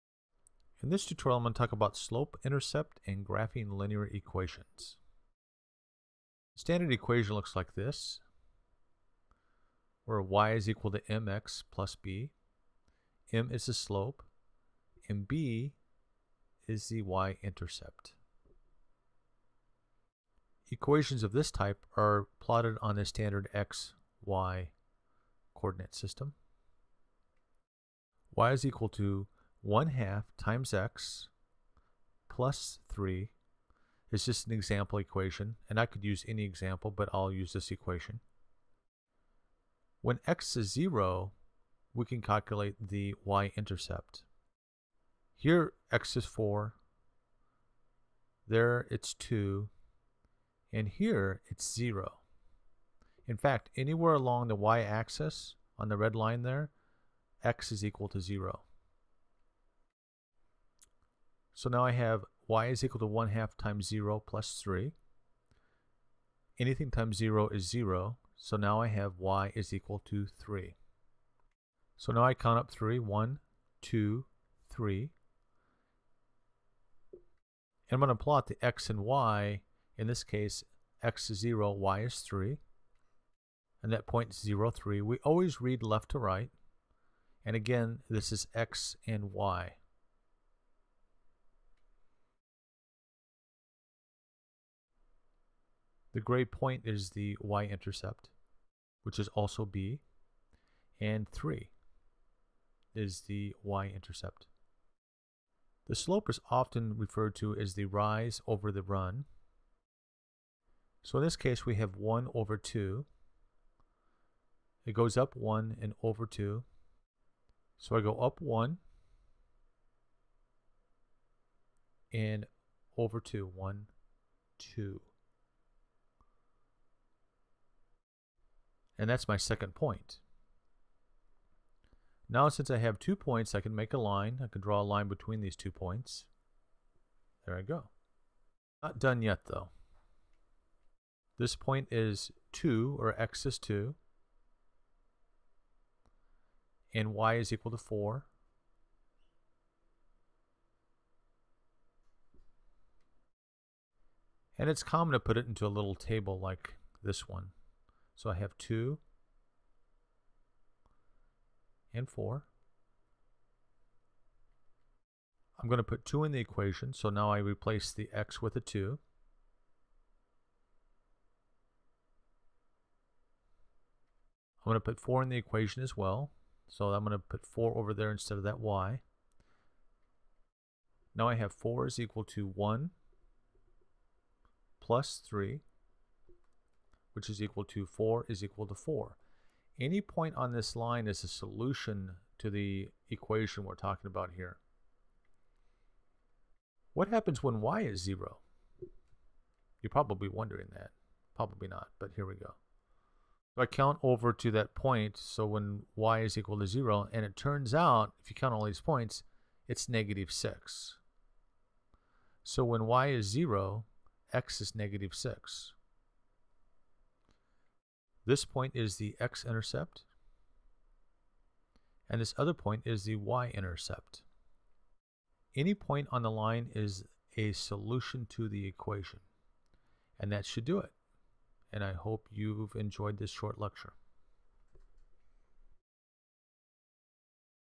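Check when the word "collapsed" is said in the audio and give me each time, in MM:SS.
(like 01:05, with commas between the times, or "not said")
not said.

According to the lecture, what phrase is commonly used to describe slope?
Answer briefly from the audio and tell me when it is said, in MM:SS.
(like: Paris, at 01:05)
rise over the run, at 01:47.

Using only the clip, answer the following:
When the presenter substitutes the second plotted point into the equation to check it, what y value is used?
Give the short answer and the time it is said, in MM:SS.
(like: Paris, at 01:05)
4, at 02:27.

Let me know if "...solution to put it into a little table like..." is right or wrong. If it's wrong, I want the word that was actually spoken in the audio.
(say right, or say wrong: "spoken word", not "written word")
wrong: "common", not "solution".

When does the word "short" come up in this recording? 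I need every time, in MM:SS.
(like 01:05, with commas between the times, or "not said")
03:53.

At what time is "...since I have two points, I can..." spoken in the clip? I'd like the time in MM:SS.
02:12.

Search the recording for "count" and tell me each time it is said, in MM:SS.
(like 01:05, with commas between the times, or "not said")
01:12, 03:23, 03:28.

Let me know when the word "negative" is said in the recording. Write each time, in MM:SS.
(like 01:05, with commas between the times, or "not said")
03:29, 03:34.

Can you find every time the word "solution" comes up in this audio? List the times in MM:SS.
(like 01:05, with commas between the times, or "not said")
03:11, 03:47.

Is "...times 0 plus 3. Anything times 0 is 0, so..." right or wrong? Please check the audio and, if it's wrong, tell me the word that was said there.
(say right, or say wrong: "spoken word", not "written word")
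right.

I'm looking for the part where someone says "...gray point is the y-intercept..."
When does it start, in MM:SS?
01:36.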